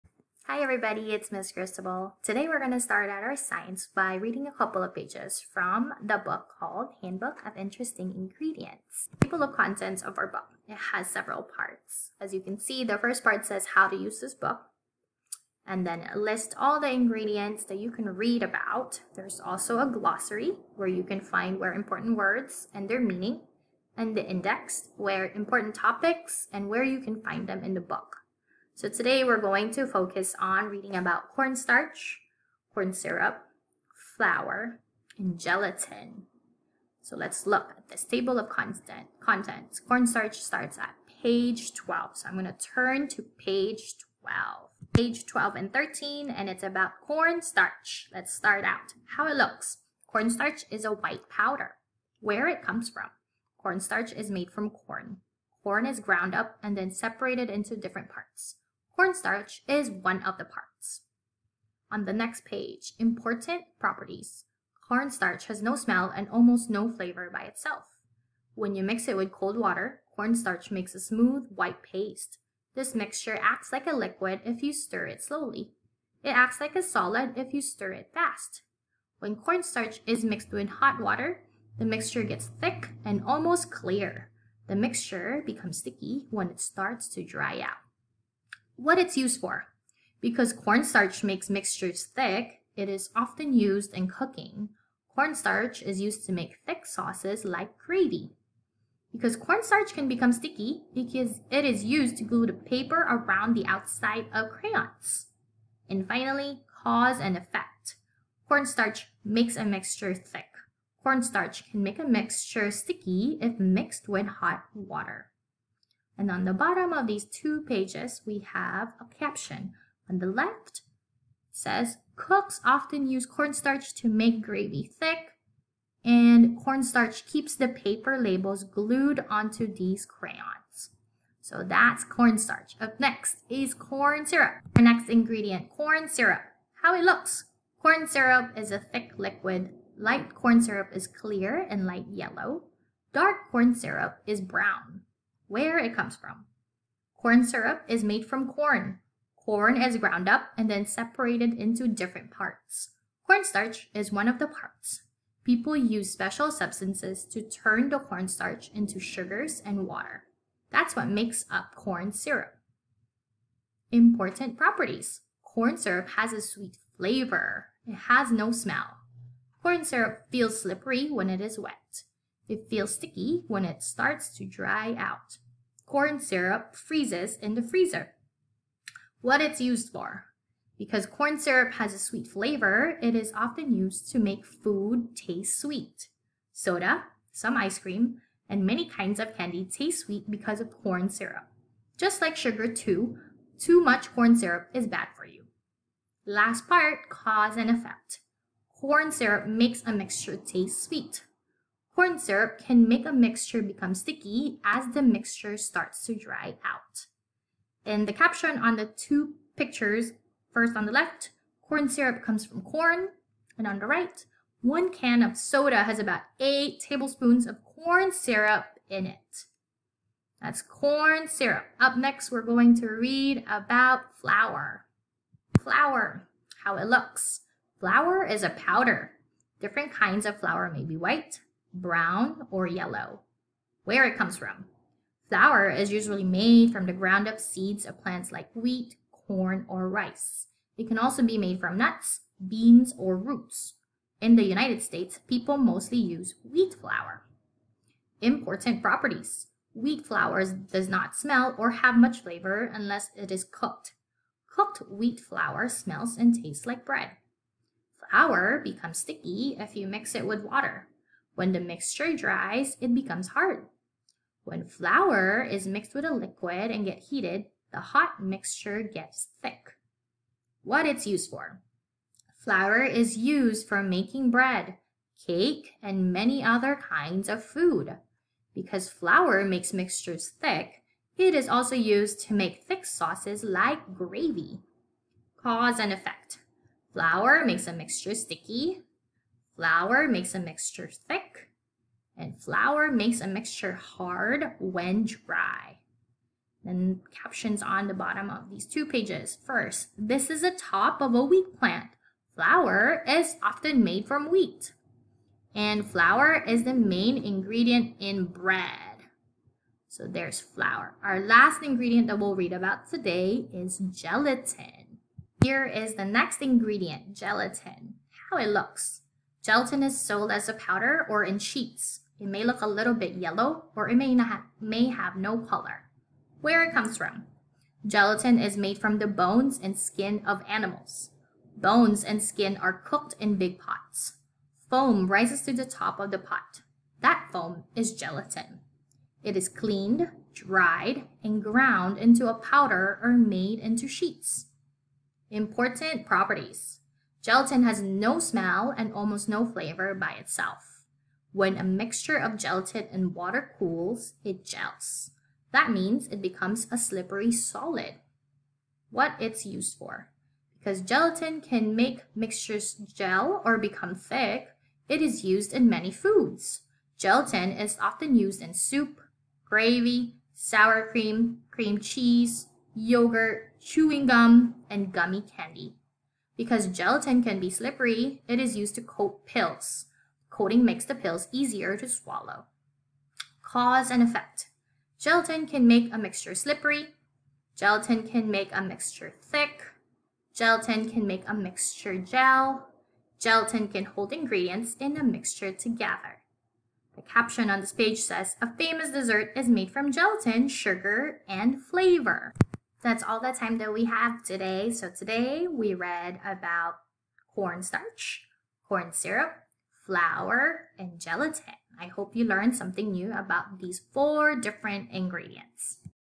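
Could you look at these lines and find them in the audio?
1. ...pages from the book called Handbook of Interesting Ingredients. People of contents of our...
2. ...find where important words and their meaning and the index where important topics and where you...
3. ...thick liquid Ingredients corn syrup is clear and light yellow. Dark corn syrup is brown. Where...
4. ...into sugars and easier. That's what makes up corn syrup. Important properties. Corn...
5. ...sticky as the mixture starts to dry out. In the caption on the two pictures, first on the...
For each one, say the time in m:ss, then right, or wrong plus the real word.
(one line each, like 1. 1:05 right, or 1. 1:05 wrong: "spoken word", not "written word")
1. 0:04 right
2. 0:21 right
3. 2:18 wrong: "Light", not "Ingredients"
4. 2:38 wrong: "water", not "easier"
5. 3:23 right.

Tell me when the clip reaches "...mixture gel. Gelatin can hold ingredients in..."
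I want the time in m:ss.
6:31.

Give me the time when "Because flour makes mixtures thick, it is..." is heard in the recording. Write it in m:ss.
4:38.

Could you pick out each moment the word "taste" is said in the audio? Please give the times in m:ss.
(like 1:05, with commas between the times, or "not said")
3:05, 3:09, 3:20, 4:16.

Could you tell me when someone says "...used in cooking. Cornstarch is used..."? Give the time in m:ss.
1:33.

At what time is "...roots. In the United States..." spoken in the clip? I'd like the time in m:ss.
4:03.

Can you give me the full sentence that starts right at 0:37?
So let's look at this table of content, contents.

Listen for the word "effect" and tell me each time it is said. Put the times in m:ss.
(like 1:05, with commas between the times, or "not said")
1:47, 3:17, 4:45, 6:24.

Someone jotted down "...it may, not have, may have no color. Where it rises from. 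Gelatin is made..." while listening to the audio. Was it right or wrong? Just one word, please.
wrong.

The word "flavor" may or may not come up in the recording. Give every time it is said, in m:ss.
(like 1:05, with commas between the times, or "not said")
1:06, 2:46, 3:02, 4:12, 5:49, 6:41.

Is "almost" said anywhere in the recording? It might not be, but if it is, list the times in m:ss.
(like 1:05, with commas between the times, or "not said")
1:06, 1:23, 5:48.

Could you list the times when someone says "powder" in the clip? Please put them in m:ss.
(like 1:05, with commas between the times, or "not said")
0:51, 3:48, 5:20, 5:42.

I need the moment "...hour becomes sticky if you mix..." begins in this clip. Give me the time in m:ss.
4:18.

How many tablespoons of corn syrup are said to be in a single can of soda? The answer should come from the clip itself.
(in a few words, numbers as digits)
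8.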